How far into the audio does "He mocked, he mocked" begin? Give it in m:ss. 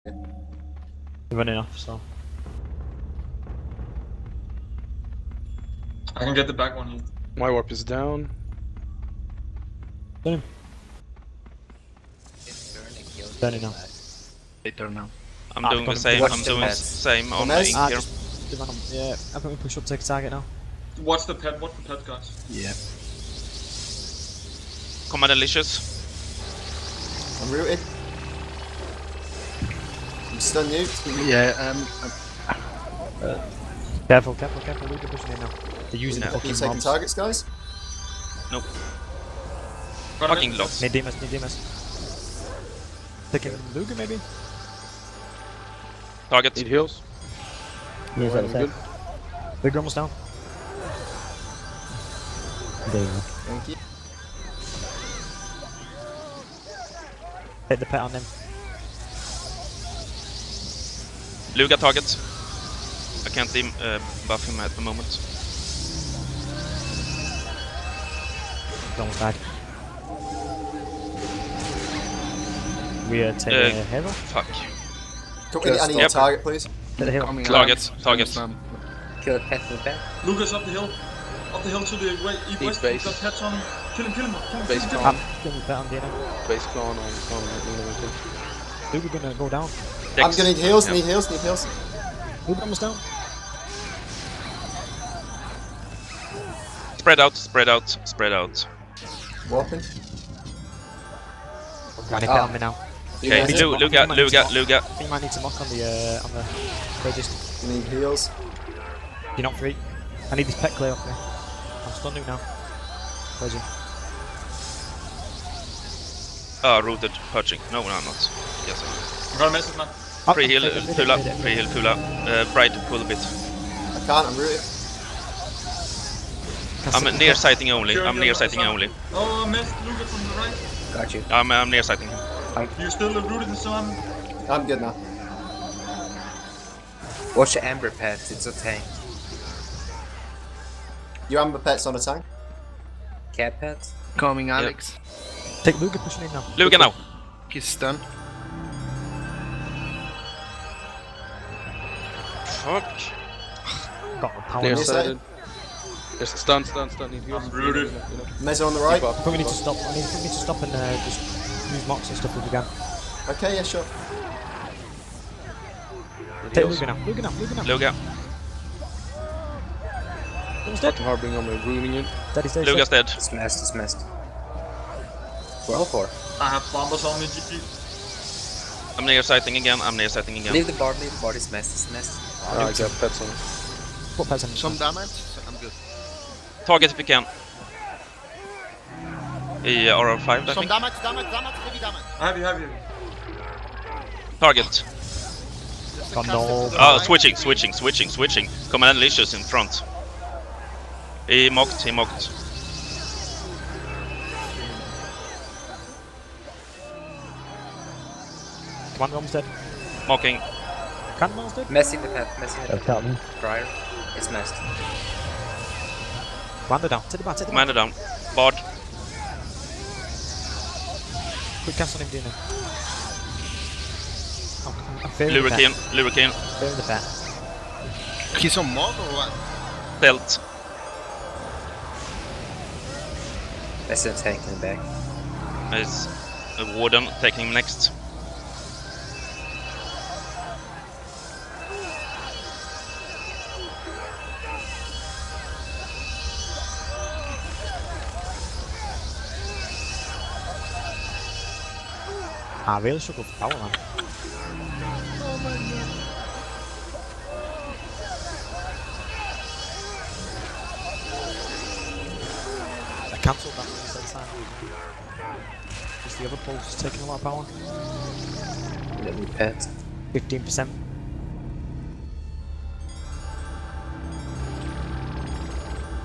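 3:21.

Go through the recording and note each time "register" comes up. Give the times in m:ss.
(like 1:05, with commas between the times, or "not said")
1:47.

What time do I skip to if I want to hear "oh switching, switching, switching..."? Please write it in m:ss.
3:16.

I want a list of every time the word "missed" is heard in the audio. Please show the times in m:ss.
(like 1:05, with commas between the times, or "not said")
2:09.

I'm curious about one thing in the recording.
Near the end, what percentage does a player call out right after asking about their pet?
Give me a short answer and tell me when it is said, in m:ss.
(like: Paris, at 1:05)
15%, at 4:30.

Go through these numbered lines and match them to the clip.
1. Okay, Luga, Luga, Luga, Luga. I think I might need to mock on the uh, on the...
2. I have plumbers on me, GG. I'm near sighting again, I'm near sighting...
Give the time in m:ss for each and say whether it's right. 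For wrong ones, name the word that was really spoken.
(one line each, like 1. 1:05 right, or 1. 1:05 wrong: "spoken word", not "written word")
1. 1:43 right
2. 2:56 right.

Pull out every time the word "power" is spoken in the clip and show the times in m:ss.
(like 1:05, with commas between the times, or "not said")
2:34, 4:27.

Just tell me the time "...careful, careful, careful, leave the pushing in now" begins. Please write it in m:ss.
0:34.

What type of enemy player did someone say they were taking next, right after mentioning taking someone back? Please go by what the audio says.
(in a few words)
warden.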